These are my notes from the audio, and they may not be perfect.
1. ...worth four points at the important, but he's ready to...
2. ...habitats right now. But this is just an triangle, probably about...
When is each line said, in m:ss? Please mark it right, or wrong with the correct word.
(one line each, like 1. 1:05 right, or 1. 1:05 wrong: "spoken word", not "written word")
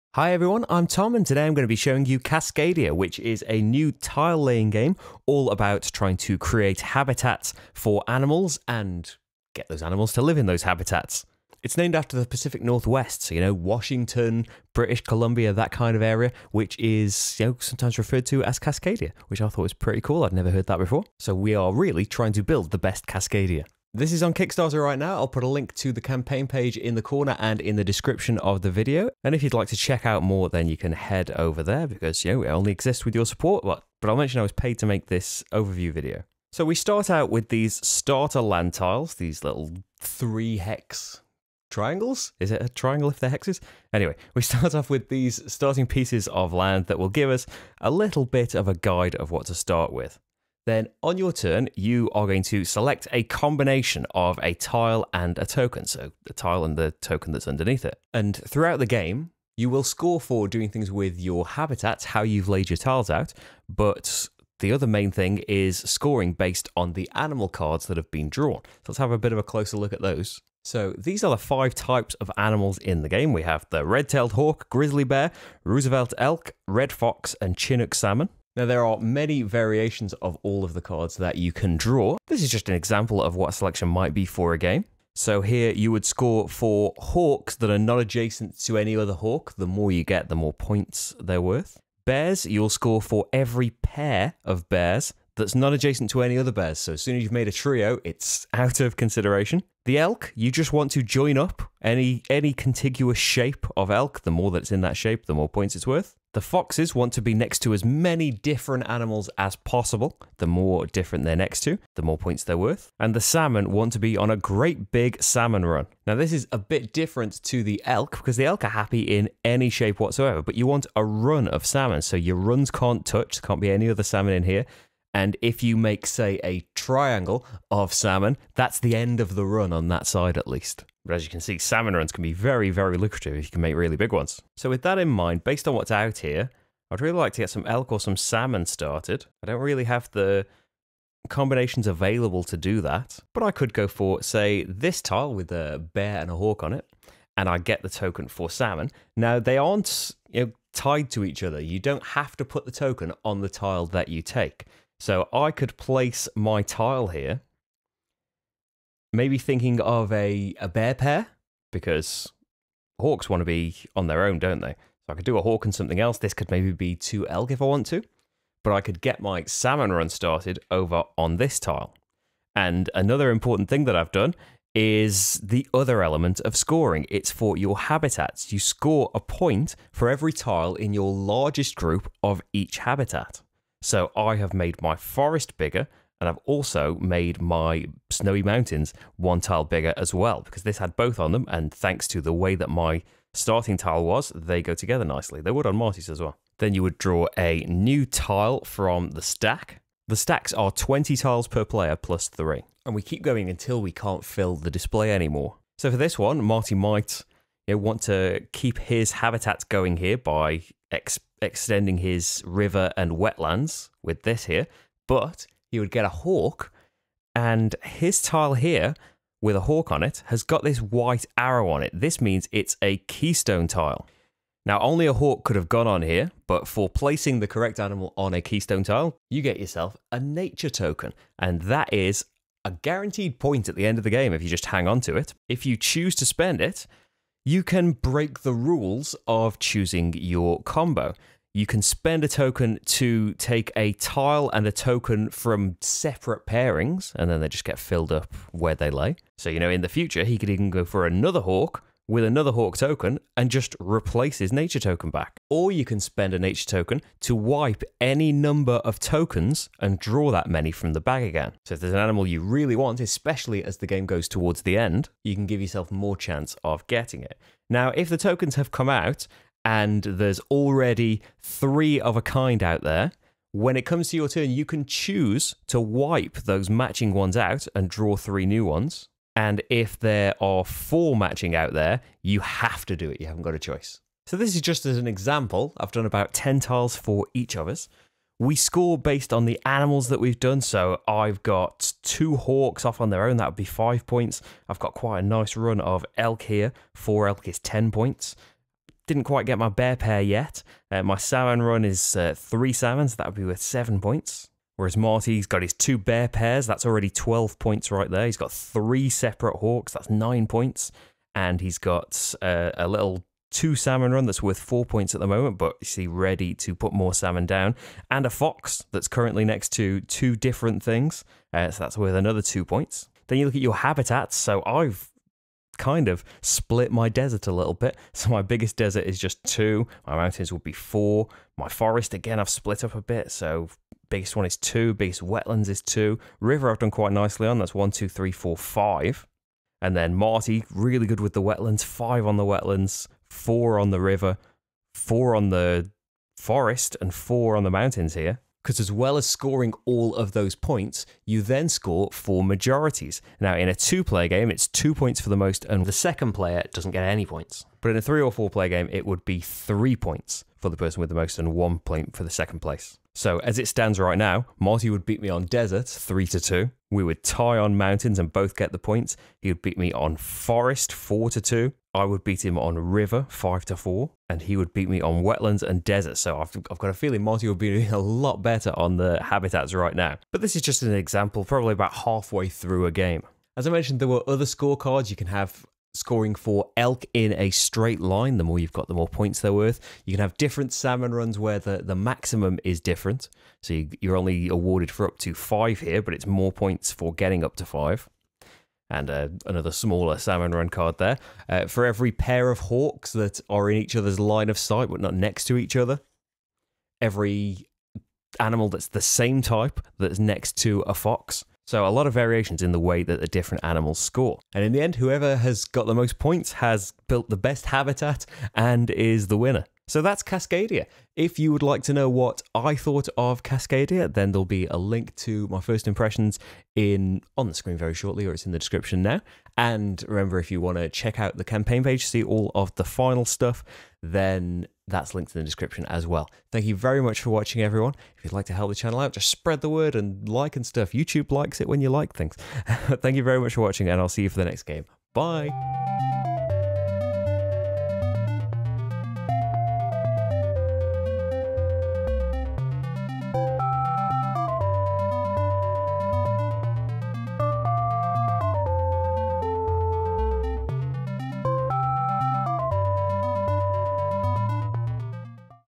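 1. 5:14 wrong: "moment", not "important"
2. 6:19 wrong: "example", not "triangle".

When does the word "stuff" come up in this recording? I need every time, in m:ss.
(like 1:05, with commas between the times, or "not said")
7:13, 7:20.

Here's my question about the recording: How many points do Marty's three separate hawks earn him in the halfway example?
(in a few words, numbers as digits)
9.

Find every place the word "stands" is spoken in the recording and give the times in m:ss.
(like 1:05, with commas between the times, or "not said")
6:03.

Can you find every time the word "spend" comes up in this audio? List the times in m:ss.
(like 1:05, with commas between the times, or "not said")
3:56, 4:01, 4:16.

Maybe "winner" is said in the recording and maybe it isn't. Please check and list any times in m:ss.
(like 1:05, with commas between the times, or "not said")
6:59.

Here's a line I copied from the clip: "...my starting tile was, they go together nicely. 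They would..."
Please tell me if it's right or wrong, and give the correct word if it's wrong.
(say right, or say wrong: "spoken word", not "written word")
right.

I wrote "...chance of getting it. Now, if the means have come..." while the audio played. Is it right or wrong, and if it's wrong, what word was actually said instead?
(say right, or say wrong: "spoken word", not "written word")
wrong: "tokens", not "means".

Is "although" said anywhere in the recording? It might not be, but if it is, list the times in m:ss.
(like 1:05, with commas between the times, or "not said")
not said.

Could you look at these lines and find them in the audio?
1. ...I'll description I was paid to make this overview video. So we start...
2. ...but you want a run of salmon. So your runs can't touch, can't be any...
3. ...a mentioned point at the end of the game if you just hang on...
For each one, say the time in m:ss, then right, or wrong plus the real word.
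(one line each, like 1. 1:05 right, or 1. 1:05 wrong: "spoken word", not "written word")
1. 0:34 wrong: "mention", not "description"
2. 2:00 right
3. 3:52 wrong: "guaranteed", not "mentioned".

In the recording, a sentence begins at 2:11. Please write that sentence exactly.
But as you can see, salmon runs can be very, very lucrative if you can make really big ones.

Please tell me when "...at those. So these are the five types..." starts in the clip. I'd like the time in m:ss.
1:09.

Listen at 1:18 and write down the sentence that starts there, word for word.
Now, there are many variations of all of the cards that you can draw.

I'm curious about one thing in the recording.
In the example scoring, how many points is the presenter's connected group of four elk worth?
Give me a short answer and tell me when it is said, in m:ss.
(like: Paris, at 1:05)
10, at 4:57.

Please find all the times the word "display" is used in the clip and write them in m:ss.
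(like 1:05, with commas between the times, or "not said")
3:24.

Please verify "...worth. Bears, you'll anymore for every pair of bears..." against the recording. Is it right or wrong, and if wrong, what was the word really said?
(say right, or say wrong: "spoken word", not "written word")
wrong: "score", not "anymore".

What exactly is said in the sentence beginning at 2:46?
This could maybe be 2 elk if I want to, but I could get my salmon run started over on this tile.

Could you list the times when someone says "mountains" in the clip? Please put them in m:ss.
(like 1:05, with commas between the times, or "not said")
3:08, 5:30, 5:47, 6:07.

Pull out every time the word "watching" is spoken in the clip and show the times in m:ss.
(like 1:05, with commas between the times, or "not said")
7:17, 7:23.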